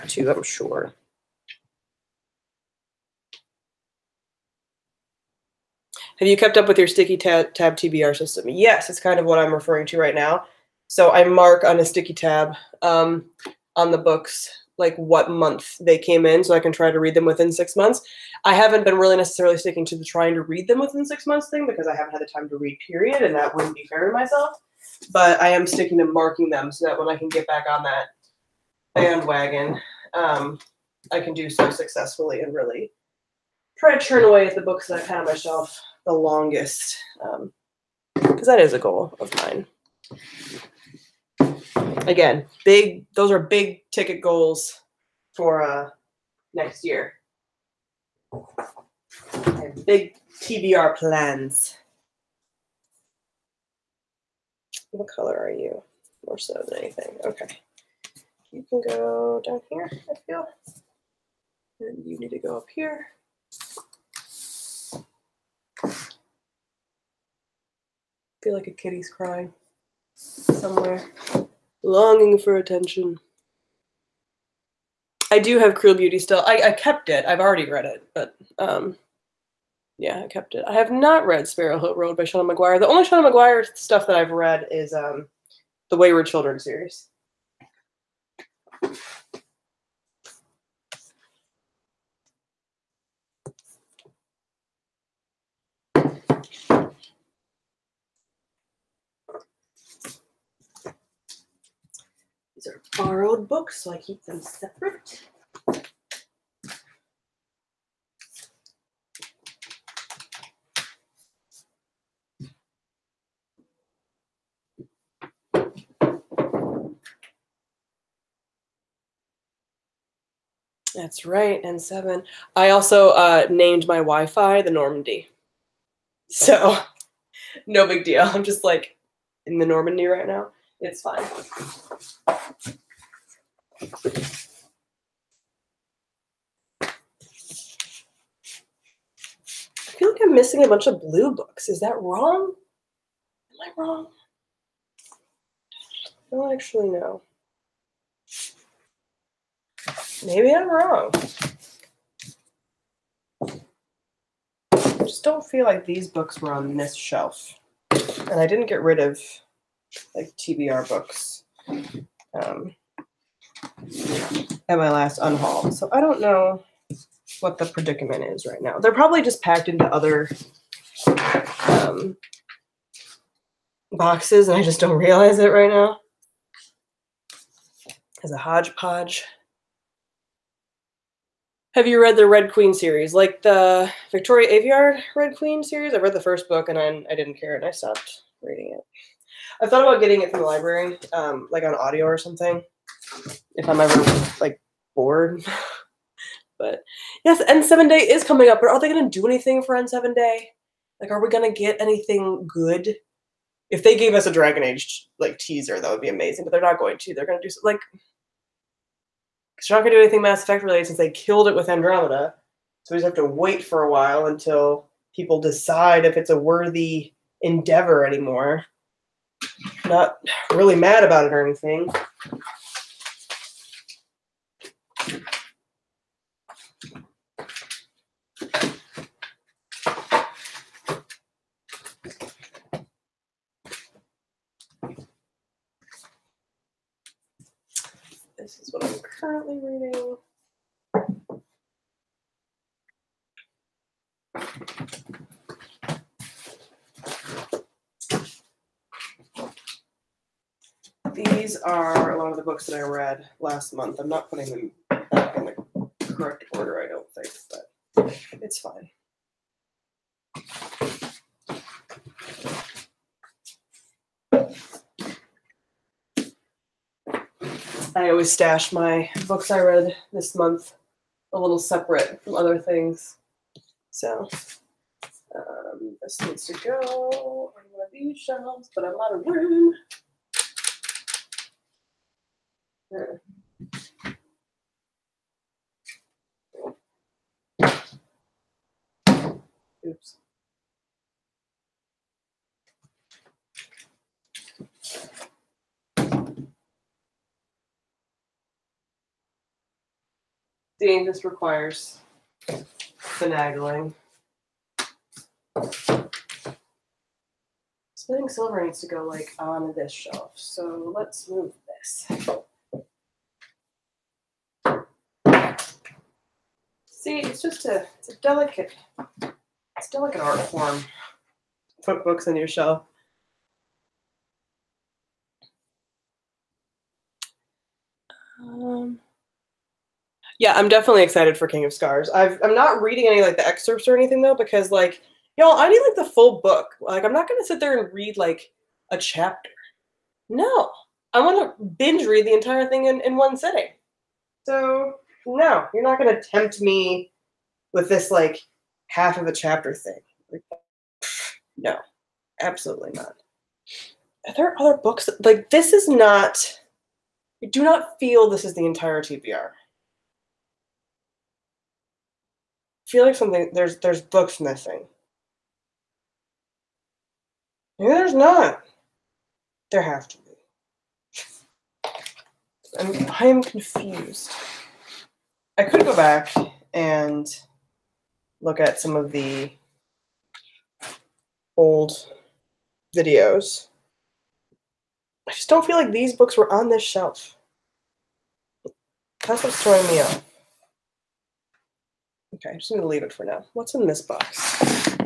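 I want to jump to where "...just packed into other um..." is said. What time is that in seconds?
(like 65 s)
169 s.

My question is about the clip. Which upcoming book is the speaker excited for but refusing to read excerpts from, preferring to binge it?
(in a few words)
King of Scars.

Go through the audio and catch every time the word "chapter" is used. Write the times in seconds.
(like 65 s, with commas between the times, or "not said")
338 s, 349 s.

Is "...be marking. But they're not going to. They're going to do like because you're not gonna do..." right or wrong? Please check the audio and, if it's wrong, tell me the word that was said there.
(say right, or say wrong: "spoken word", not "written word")
wrong: "amazing", not "marking".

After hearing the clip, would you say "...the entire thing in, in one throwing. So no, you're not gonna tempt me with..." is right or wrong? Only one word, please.
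wrong.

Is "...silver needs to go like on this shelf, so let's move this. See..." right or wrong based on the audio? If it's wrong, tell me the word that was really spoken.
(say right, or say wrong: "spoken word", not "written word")
right.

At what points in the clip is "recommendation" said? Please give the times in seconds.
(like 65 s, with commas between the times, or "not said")
not said.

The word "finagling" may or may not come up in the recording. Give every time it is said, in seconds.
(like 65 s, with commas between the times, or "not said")
303 s.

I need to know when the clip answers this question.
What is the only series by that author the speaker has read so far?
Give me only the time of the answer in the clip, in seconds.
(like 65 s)
85 s.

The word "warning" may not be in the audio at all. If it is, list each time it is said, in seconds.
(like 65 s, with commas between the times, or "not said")
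not said.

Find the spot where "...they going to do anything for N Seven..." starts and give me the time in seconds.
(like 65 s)
198 s.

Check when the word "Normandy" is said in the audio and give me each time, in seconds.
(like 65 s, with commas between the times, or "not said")
124 s, 129 s.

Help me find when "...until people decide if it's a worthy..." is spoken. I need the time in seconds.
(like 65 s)
214 s.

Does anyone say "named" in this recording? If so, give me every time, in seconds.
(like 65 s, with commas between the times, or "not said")
123 s.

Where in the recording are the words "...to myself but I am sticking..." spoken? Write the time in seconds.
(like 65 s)
24 s.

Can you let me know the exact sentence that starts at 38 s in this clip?
Because um, that is a goal of mine.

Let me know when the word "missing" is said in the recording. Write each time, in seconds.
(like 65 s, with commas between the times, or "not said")
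140 s, 364 s.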